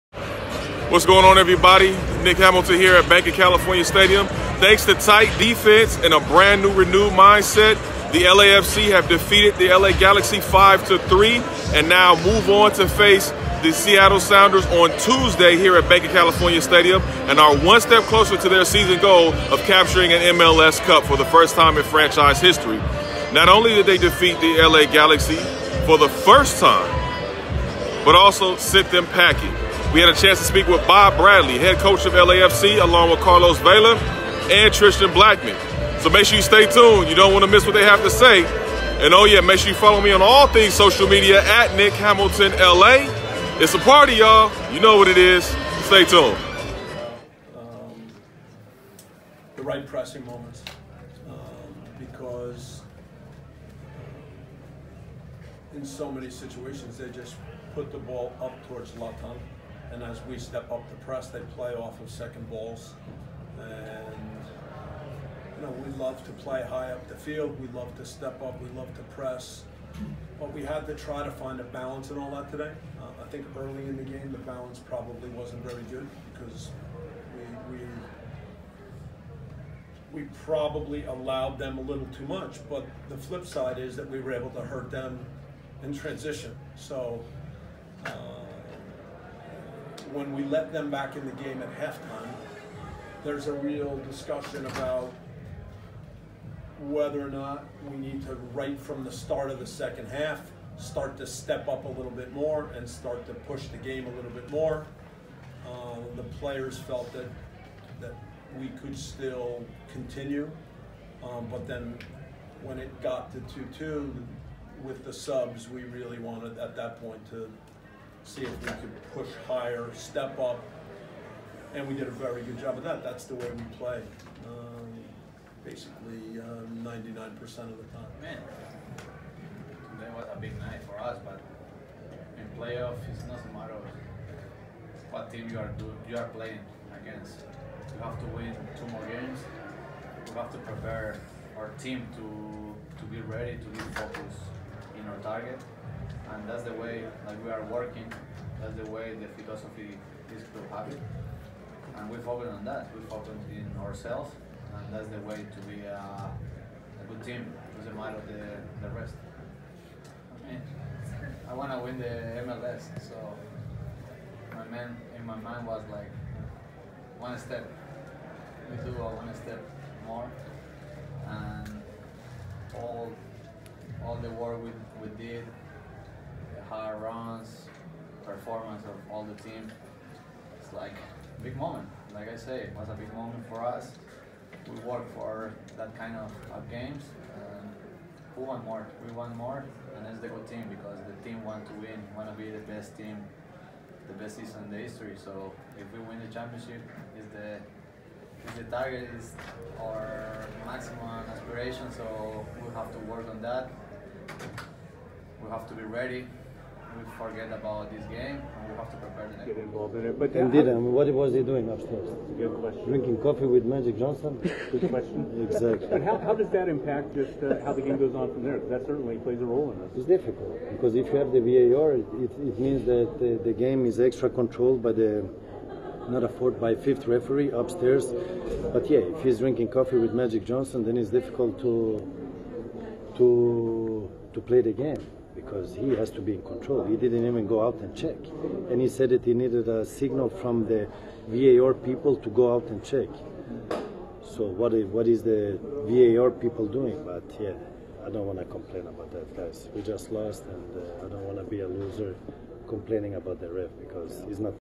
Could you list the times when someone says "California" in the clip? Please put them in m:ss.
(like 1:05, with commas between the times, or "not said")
0:03, 0:16.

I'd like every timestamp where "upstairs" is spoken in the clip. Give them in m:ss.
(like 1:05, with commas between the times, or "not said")
3:31, 3:47.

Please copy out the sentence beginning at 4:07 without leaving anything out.
But yeah, I don't want to complain about that, guys.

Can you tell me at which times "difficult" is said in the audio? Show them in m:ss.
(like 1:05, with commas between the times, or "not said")
3:40, 3:51.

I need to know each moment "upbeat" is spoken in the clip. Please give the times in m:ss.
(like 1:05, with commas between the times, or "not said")
not said.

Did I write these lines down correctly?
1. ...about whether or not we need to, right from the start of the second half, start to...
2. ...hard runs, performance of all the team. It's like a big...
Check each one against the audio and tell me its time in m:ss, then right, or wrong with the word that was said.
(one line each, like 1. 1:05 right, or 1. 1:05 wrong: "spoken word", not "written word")
1. 1:34 right
2. 2:56 right.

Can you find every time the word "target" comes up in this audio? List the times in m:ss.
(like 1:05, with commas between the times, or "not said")
2:25, 3:18.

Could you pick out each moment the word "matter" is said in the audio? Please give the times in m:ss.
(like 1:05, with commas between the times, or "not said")
2:13, 2:37.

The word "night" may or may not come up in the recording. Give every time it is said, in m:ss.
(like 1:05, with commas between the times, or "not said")
2:10.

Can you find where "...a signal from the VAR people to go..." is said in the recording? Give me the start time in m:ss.
3:59.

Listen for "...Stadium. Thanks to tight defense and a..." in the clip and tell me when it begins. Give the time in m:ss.
0:03.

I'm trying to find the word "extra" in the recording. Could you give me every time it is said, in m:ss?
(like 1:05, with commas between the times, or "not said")
3:44.